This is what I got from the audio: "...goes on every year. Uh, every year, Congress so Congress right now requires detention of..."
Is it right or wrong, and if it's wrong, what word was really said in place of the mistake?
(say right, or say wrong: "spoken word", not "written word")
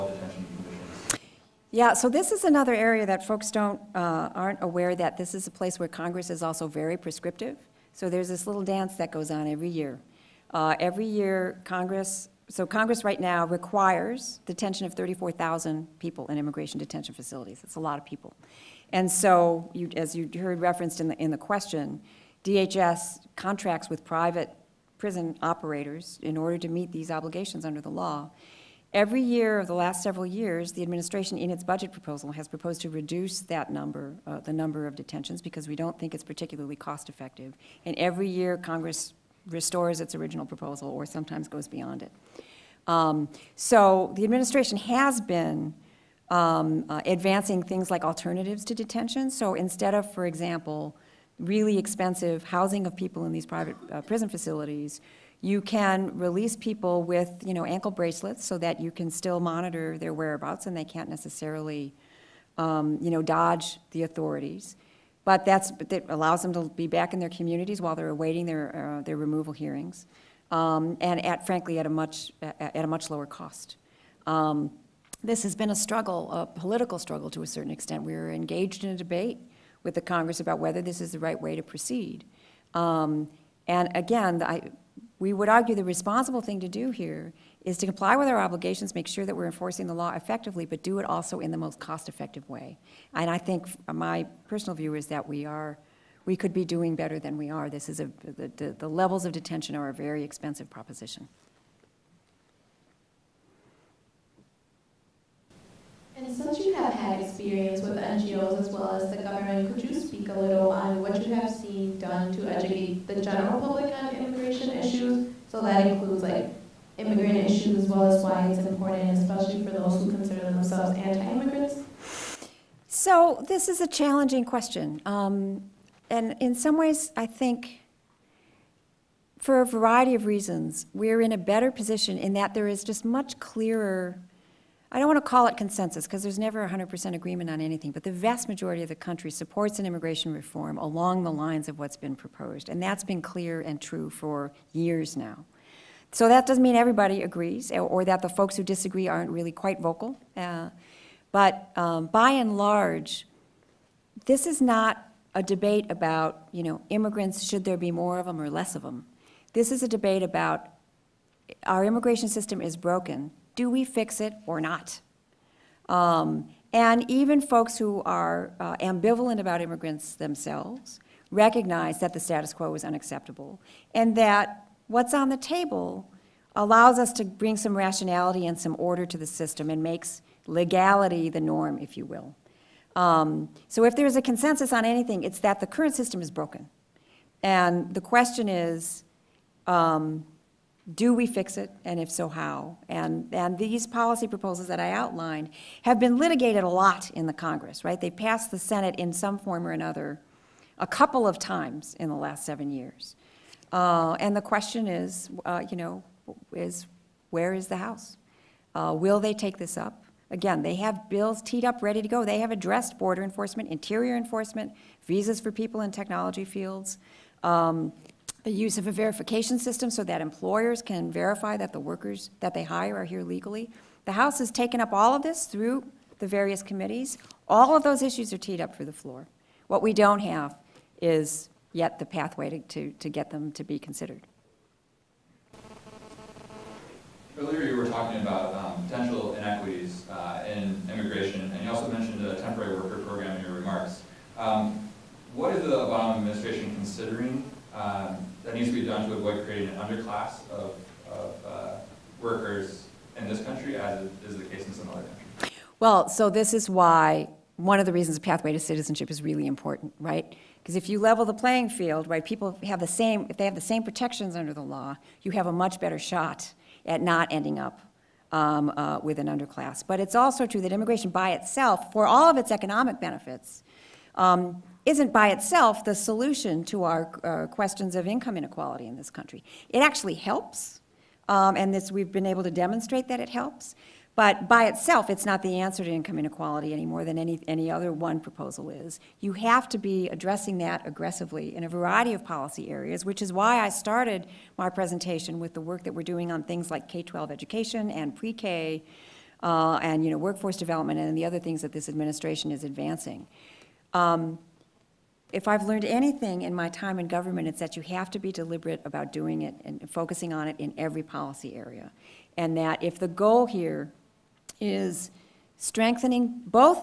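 right.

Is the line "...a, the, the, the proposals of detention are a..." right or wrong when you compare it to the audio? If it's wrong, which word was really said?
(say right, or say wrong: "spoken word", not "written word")
wrong: "levels", not "proposals".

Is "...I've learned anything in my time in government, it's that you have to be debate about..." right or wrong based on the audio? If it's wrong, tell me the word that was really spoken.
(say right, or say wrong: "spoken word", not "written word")
wrong: "deliberate", not "debate".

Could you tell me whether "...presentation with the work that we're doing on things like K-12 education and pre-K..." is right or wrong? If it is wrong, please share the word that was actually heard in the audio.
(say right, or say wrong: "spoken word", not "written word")
right.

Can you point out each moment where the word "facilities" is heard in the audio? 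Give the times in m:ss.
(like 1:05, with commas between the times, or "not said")
0:17, 0:54.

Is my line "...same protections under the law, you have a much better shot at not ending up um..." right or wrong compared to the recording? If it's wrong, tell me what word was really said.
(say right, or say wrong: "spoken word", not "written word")
right.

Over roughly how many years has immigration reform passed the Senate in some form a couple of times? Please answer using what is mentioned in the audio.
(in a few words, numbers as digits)
7.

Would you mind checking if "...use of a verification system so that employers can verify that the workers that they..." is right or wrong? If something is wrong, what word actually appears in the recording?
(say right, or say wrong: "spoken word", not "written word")
right.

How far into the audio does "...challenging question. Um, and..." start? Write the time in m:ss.
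2:03.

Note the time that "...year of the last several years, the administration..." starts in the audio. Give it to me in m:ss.
0:29.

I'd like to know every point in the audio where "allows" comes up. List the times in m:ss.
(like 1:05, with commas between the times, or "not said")
1:06, 2:56.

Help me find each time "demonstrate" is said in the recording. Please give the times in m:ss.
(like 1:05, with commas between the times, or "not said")
4:42.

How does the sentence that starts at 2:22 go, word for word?
And that's been clear and true for years now.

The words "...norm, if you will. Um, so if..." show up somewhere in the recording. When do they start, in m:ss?
3:01.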